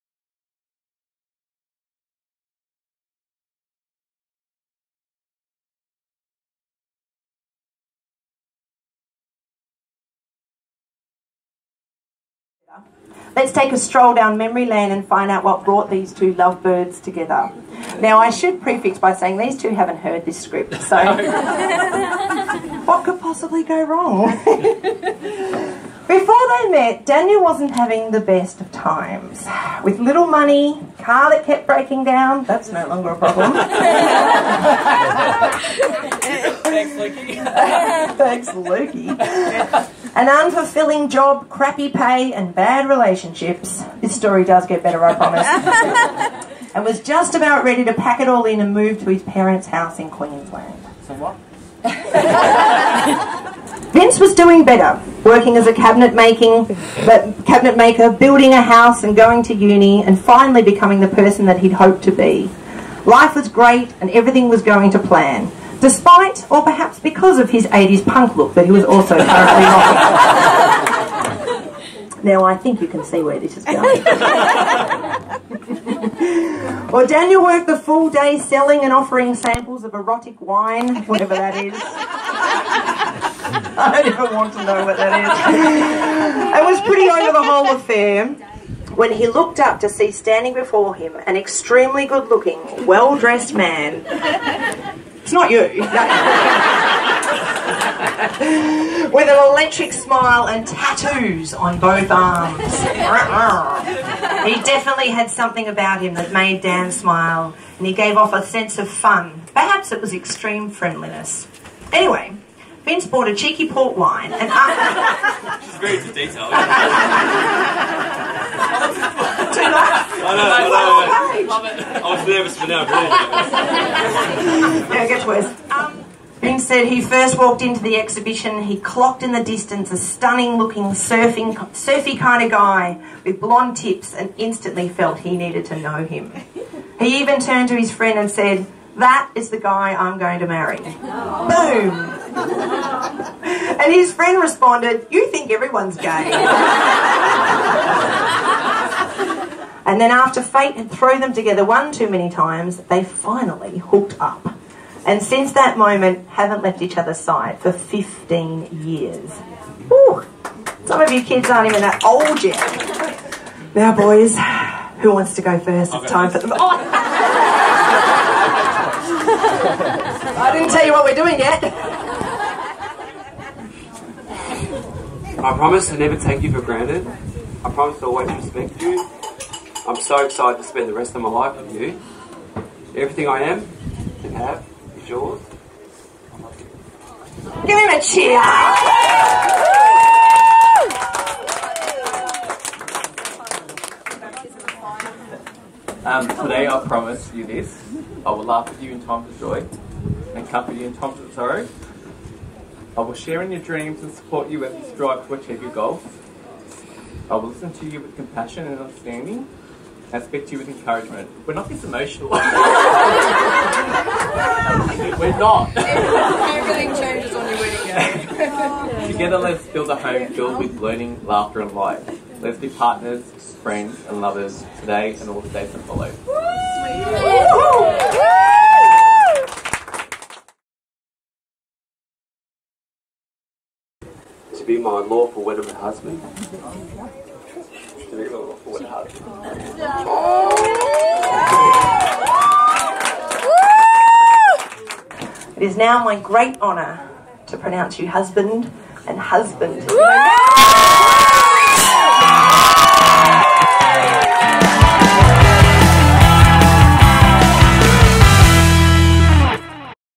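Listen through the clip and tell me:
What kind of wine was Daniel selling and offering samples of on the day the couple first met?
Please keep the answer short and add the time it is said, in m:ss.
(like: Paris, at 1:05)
Erotic wine, at 1:19.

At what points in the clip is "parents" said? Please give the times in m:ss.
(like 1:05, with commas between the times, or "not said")
0:49.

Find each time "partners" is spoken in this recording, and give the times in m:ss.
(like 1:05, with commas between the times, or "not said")
3:42.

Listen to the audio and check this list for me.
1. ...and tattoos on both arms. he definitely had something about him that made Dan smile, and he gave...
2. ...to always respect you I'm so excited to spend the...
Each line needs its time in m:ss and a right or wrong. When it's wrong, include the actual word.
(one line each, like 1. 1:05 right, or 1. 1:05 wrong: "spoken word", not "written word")
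1. 1:40 right
2. 2:57 right.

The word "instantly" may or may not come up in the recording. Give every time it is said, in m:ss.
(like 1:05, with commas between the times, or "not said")
2:14.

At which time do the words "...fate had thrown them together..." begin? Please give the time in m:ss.
2:30.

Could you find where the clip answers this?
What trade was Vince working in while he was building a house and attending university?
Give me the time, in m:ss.
0:57.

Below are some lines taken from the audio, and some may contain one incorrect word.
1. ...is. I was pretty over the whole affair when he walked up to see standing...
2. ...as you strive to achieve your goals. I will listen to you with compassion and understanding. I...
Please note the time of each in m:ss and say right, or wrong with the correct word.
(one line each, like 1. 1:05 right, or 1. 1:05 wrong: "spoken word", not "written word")
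1. 1:26 wrong: "looked", not "walked"
2. 3:24 right.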